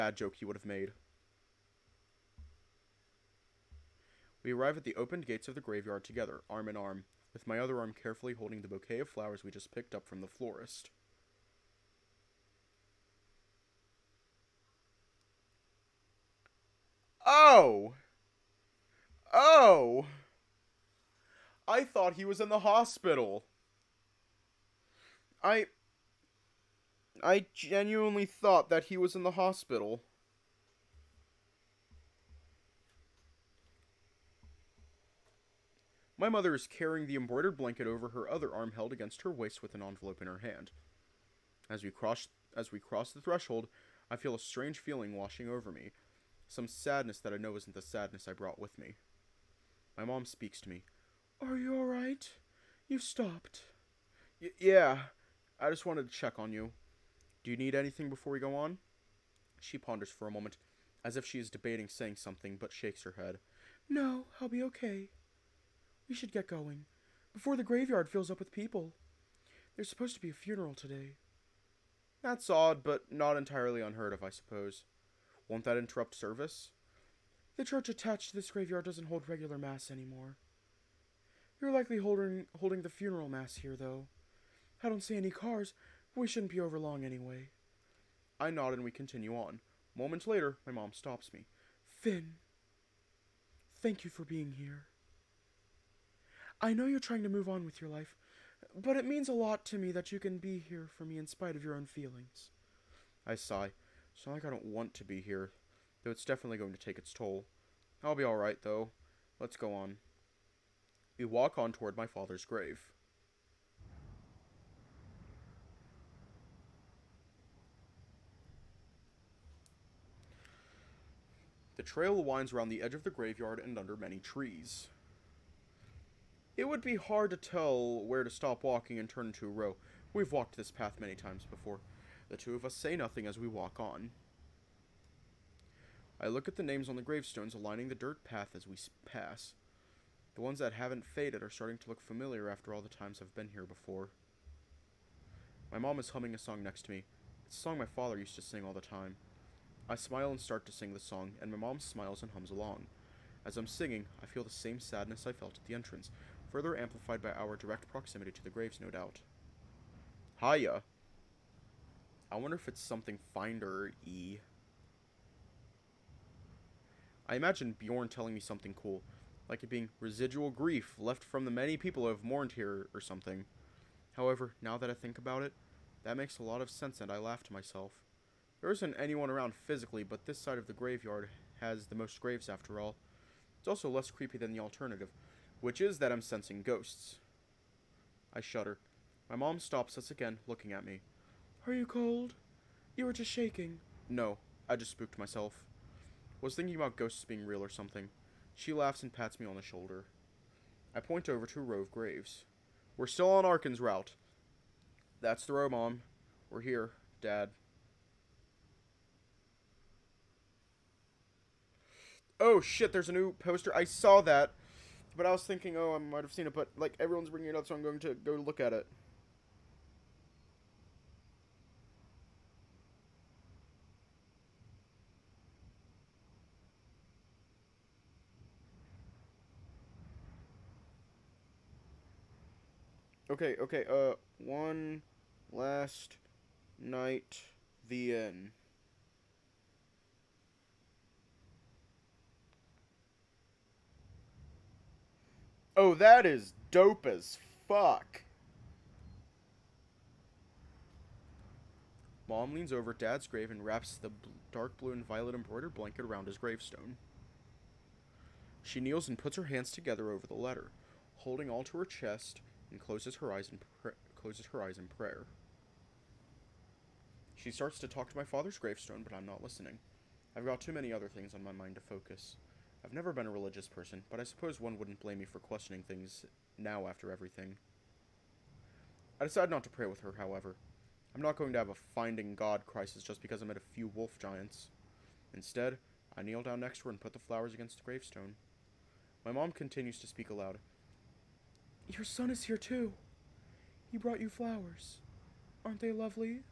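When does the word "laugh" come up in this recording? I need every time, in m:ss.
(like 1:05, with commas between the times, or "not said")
2:57, 3:18.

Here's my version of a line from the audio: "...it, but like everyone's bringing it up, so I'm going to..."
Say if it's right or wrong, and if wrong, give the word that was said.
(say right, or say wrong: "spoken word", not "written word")
right.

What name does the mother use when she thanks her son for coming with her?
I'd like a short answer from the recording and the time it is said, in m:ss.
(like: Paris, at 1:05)
Finn, at 1:31.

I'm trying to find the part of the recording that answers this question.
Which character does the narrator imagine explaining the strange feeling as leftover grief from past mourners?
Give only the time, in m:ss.
2:47.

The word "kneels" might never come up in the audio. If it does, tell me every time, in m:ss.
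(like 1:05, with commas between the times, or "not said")
4:18, 4:46.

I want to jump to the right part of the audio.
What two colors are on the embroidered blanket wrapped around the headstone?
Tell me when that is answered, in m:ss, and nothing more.
4:14.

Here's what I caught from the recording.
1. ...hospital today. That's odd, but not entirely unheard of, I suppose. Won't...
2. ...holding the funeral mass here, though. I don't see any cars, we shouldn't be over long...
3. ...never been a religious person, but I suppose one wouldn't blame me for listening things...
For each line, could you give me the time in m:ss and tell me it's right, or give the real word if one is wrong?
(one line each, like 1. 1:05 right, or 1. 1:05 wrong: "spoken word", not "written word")
1. 1:10 wrong: "funeral", not "hospital"
2. 1:22 right
3. 4:32 wrong: "questioning", not "listening".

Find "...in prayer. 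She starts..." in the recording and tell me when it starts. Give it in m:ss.
4:24.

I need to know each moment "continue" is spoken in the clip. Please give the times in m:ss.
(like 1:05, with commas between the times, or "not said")
1:28, 4:49.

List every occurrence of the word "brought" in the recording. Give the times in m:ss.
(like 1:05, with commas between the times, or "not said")
0:48, 4:53.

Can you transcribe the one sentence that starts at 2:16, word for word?
I look at the names on the gravestones aligning the dirt path as we pass.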